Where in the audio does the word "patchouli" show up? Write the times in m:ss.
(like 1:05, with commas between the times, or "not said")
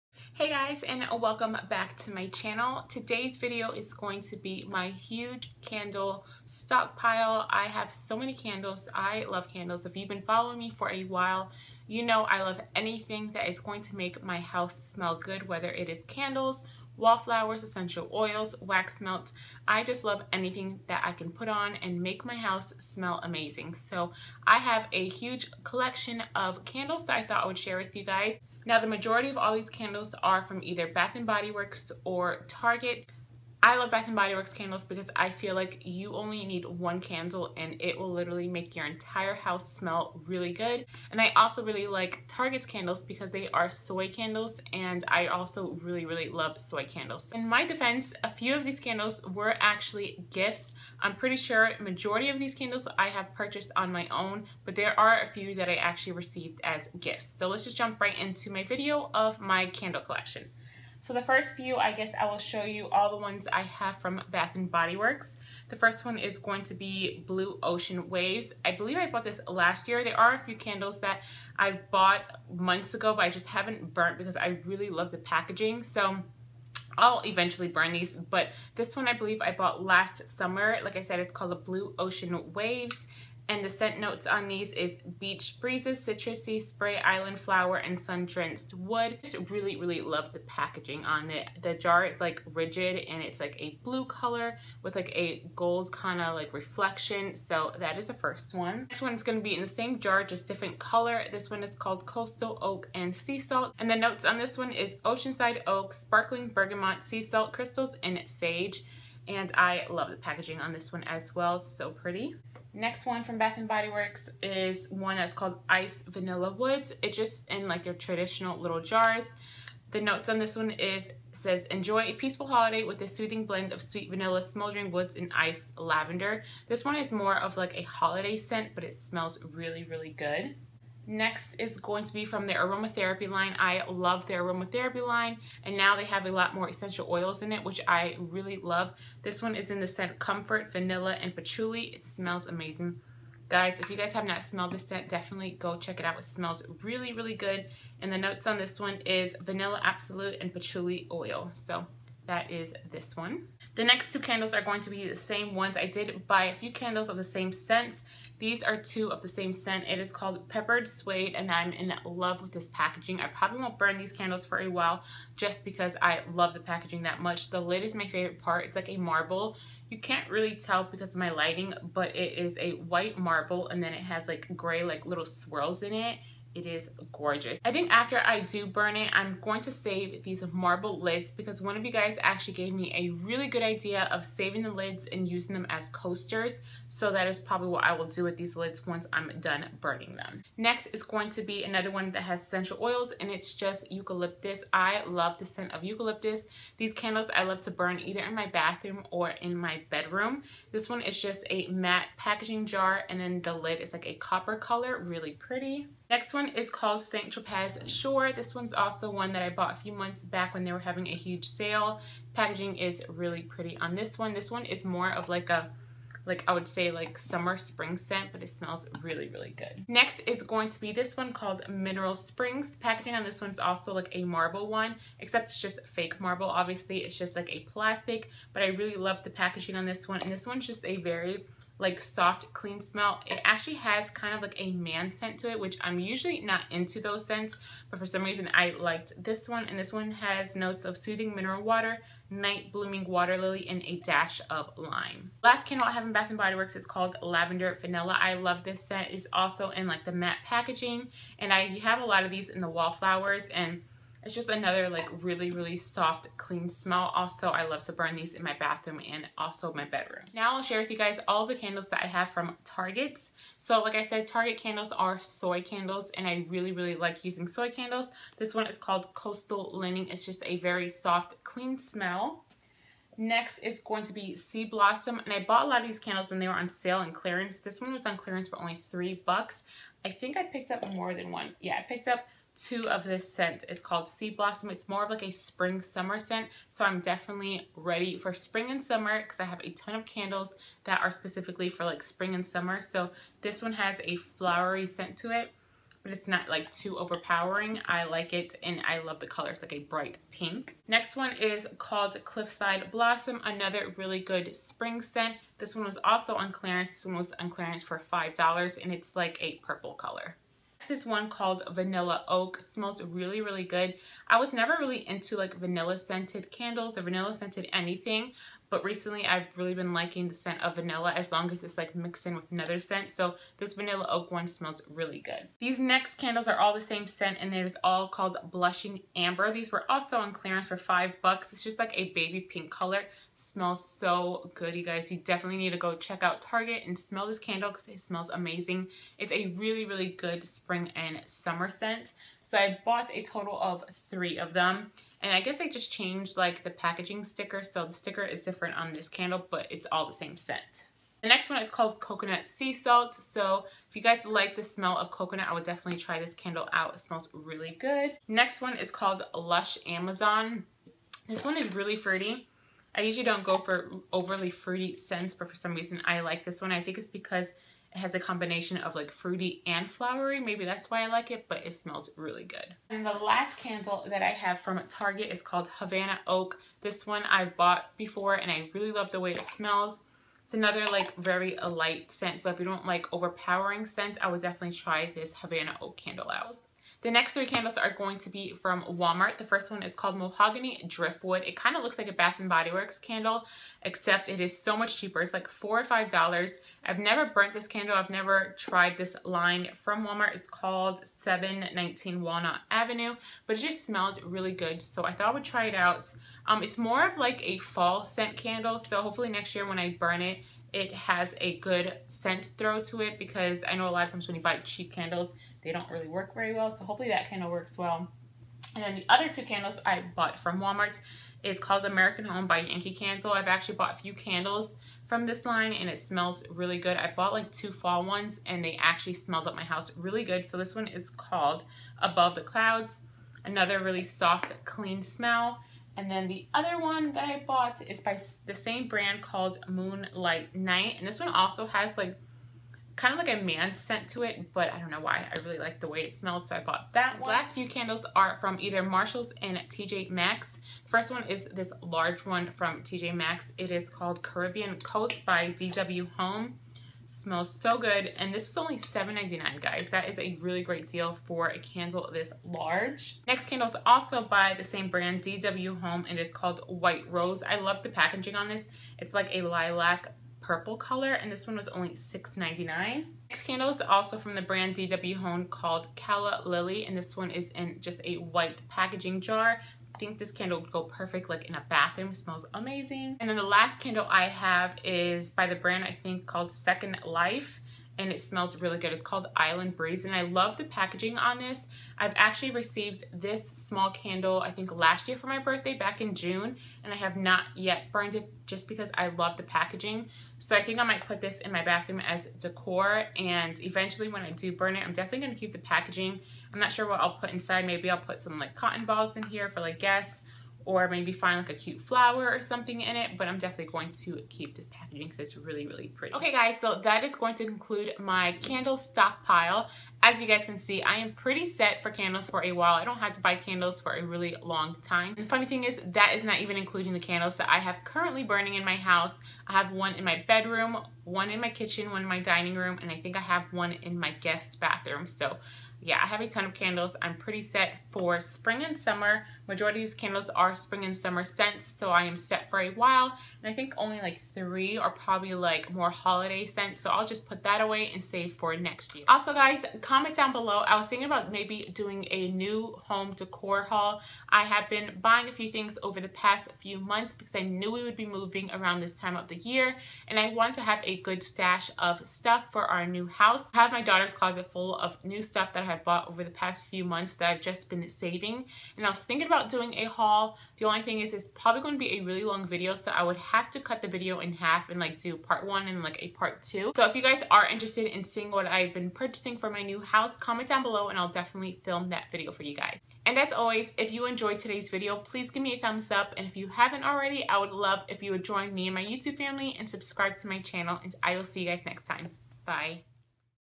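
2:21, 2:30.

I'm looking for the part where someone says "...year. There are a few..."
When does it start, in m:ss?
1:09.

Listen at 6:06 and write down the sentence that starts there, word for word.
I think it's because it has a combination of like fruity and flowery.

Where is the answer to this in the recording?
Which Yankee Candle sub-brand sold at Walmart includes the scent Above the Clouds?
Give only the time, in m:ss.
7:01.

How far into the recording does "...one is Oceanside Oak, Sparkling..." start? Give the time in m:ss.
1:44.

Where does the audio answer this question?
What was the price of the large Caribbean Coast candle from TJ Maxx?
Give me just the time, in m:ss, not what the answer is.
7:38.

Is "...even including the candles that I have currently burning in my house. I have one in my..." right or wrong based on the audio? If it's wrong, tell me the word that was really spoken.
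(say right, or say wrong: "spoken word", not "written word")
right.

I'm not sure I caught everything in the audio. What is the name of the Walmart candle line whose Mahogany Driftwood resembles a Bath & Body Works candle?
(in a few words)
719 Walnut Avenue.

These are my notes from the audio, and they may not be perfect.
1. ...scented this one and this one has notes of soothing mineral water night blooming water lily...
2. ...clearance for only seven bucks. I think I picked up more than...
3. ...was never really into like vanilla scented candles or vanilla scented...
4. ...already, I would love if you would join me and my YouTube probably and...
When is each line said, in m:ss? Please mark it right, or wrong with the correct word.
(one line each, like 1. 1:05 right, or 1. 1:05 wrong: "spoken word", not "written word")
1. 3:58 wrong: "liked", not "scented"
2. 4:38 wrong: "three", not "seven"
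3. 5:14 right
4. 9:46 wrong: "family", not "probably".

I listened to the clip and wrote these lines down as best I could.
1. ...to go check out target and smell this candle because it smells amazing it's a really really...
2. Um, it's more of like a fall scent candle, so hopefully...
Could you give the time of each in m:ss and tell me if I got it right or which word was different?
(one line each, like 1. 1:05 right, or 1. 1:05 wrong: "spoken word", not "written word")
1. 5:35 right
2. 6:46 right.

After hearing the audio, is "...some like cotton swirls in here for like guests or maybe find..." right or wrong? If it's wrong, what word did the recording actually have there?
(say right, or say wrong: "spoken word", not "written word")
wrong: "balls", not "swirls".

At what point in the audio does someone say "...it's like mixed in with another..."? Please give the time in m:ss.
5:21.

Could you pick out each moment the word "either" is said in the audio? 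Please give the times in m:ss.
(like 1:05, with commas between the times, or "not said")
0:30, 3:17, 7:28.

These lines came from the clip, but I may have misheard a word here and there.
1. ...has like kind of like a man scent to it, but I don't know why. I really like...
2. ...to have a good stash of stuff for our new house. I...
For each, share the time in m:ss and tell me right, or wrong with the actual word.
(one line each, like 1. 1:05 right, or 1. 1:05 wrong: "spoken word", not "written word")
1. 7:21 right
2. 9:20 right.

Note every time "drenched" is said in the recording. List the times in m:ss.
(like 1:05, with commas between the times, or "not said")
1:27.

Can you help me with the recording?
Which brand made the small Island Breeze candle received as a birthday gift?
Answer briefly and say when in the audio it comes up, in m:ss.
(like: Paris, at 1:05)
Second Life, at 8:06.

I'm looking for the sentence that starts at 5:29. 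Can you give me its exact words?
These were also on clearance for five bucks.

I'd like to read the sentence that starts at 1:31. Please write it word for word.
The jar is like rigid and it's like a blue color with like a gold kind of like reflection.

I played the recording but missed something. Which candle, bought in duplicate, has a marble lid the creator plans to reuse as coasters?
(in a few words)
Peppered Suede.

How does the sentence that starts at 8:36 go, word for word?
Okay guys, so that is going to conclude my candle stockpile.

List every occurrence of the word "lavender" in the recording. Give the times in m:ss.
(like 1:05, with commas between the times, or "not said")
2:05, 4:07.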